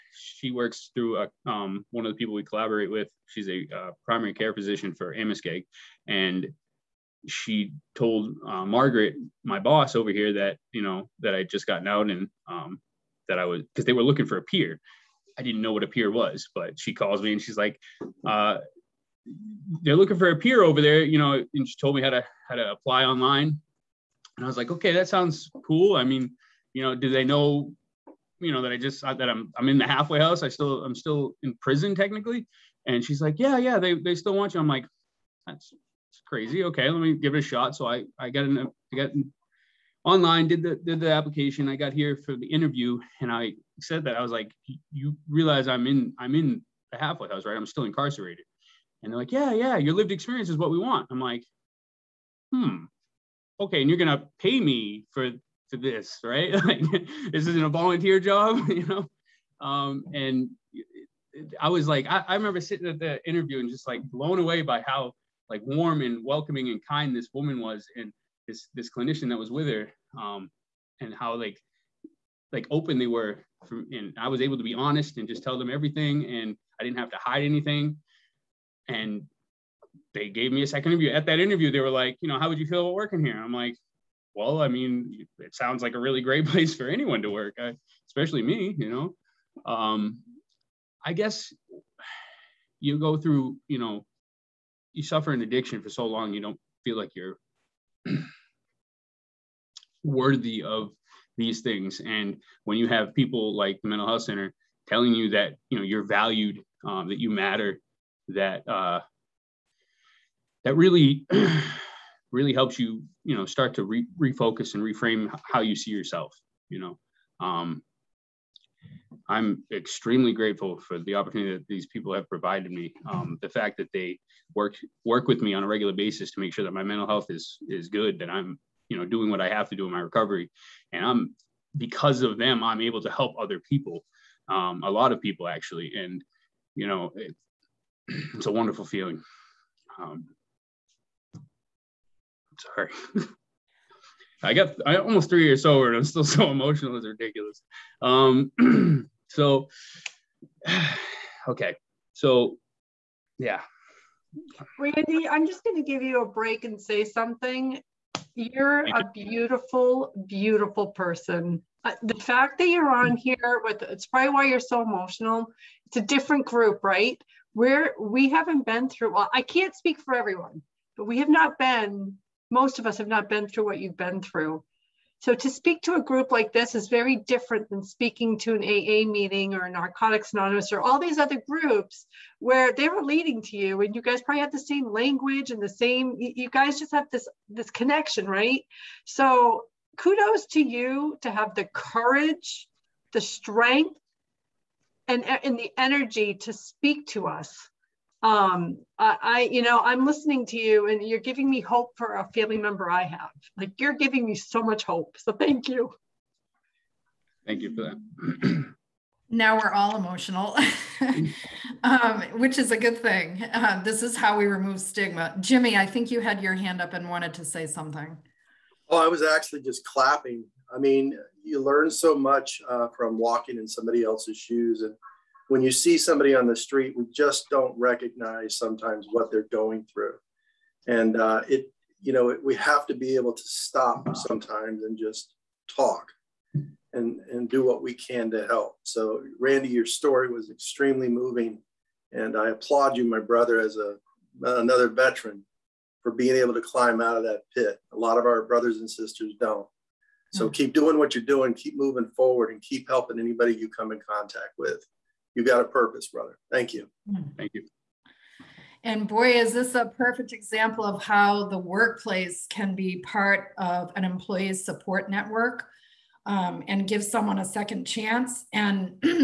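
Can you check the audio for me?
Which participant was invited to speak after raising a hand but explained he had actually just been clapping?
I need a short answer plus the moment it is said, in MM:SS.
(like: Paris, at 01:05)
Jimmy, at 03:35.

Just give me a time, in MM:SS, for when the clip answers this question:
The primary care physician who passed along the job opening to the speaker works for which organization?
00:05.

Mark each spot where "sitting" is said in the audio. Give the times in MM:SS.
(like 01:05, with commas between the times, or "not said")
01:02.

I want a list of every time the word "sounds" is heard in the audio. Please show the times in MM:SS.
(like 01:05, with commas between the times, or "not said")
00:25, 01:25.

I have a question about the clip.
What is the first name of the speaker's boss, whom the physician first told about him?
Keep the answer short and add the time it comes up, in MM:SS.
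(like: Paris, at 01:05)
Margaret, at 00:08.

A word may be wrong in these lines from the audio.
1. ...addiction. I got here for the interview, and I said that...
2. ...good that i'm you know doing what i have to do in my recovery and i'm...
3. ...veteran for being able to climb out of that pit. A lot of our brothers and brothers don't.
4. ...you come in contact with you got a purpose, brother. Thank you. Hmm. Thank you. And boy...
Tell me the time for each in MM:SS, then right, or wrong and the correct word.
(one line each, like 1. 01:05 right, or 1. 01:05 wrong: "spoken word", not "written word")
1. 00:41 wrong: "application", not "addiction"
2. 02:07 right
3. 04:04 wrong: "sisters", not "brothers"
4. 04:13 right.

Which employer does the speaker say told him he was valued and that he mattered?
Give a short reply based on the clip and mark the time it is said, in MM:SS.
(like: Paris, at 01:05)
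the mental health center, at 01:43.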